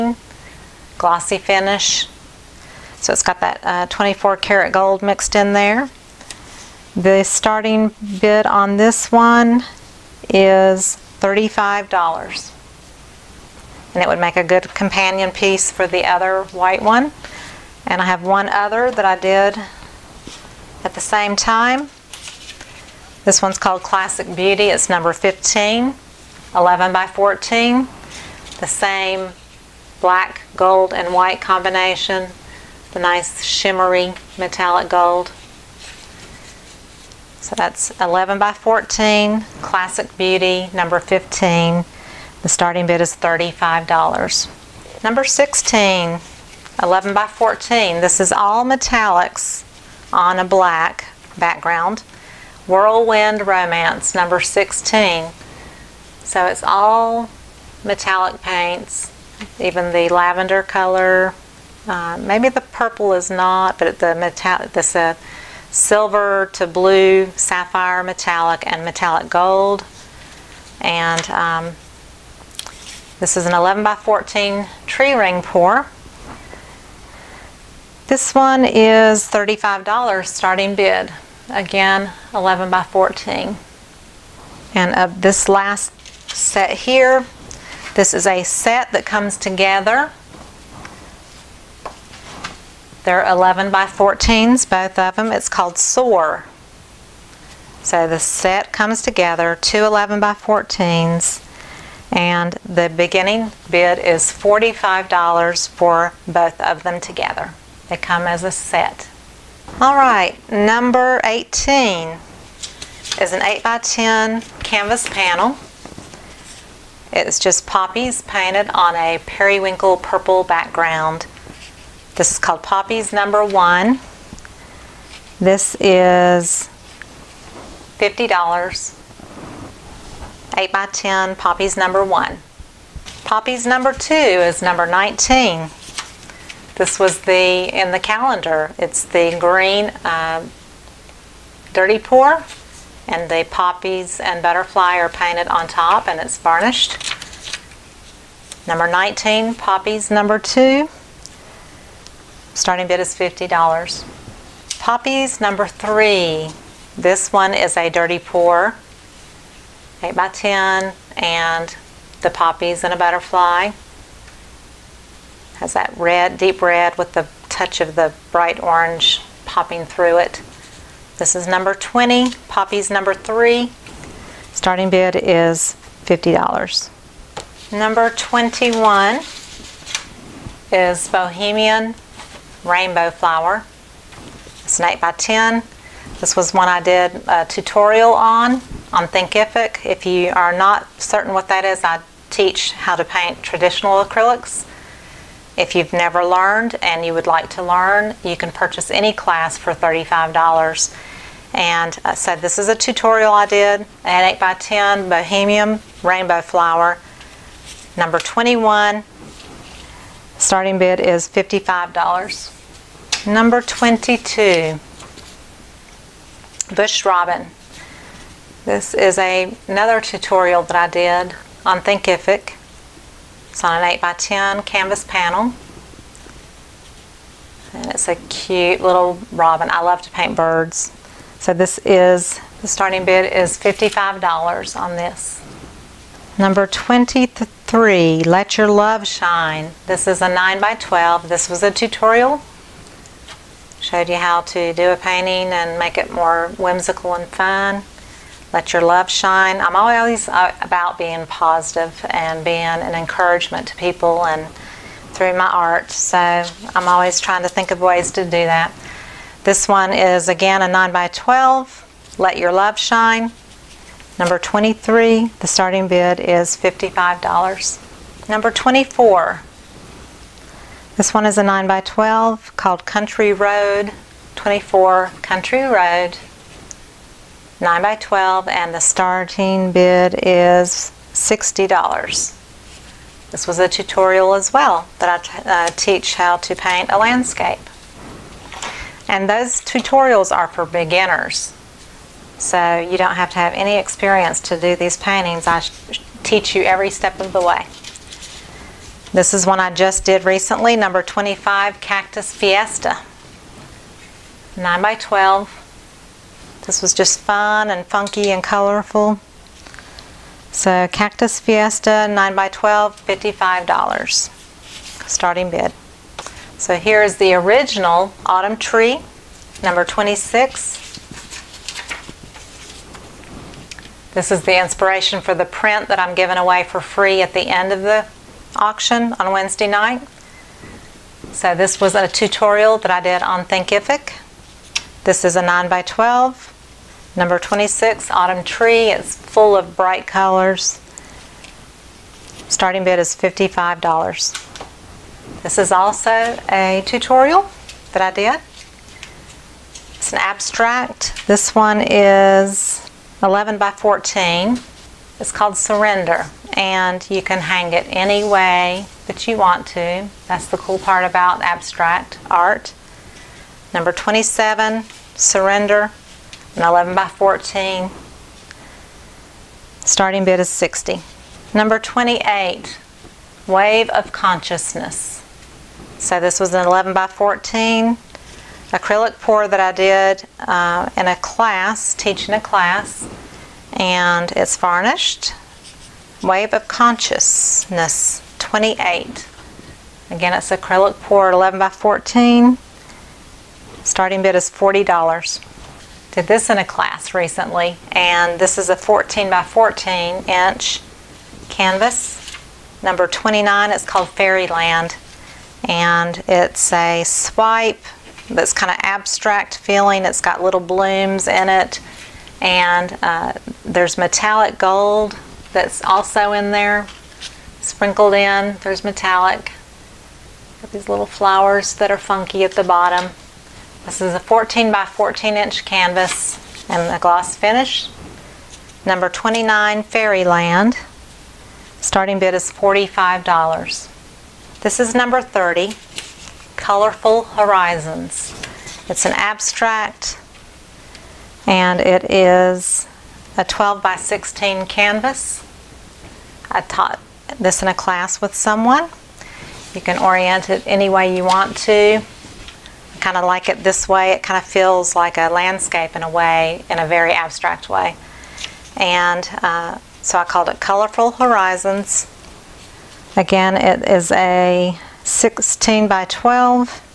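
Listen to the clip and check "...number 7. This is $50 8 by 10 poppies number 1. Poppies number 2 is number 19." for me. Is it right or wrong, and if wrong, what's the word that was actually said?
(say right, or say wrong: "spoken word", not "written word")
wrong: "1", not "7".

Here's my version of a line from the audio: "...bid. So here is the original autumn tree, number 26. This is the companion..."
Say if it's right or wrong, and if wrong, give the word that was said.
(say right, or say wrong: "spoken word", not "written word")
wrong: "inspiration", not "companion".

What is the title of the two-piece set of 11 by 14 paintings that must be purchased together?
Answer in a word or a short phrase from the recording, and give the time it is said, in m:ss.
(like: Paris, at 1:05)
SOAR, at 1:35.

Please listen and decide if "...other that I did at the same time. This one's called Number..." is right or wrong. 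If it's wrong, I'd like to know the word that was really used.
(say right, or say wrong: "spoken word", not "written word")
wrong: "Classic", not "Number".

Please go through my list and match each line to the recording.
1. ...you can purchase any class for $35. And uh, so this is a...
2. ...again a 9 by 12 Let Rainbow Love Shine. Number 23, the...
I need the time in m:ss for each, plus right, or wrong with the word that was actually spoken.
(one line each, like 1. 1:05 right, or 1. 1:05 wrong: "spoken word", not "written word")
1. 3:18 right
2. 4:20 wrong: "Your", not "Rainbow".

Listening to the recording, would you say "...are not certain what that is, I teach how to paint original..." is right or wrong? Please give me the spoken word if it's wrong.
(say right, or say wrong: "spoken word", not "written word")
wrong: "traditional", not "original".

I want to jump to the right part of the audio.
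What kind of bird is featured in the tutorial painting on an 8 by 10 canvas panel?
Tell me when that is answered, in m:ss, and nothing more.
3:36.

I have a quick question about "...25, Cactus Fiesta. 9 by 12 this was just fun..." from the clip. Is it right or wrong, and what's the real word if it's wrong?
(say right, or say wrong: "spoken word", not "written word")
right.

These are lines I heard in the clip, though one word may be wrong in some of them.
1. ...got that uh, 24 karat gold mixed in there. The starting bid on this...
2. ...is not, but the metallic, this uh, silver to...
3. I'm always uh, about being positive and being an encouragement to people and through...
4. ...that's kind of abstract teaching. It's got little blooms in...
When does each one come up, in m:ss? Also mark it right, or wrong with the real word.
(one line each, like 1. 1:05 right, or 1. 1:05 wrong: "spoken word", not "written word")
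1. 0:03 right
2. 1:03 right
3. 4:09 right
4. 6:48 wrong: "feeling", not "teaching".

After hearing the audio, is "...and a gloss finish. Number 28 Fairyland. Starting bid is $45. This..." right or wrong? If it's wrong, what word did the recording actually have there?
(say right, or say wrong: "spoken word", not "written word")
wrong: "29", not "28".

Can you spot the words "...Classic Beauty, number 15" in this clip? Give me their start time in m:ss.
0:39.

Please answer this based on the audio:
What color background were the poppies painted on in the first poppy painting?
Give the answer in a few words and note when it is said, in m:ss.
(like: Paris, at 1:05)
periwinkle purple, at 1:59.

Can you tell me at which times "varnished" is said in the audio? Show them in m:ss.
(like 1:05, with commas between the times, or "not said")
2:26, 6:24.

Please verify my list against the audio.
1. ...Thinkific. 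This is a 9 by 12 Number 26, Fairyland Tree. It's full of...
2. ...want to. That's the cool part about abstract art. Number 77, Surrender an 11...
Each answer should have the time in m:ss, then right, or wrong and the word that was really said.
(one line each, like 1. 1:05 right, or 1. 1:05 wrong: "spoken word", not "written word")
1. 5:33 wrong: "Autumn", not "Fairyland"
2. 5:59 wrong: "27", not "77".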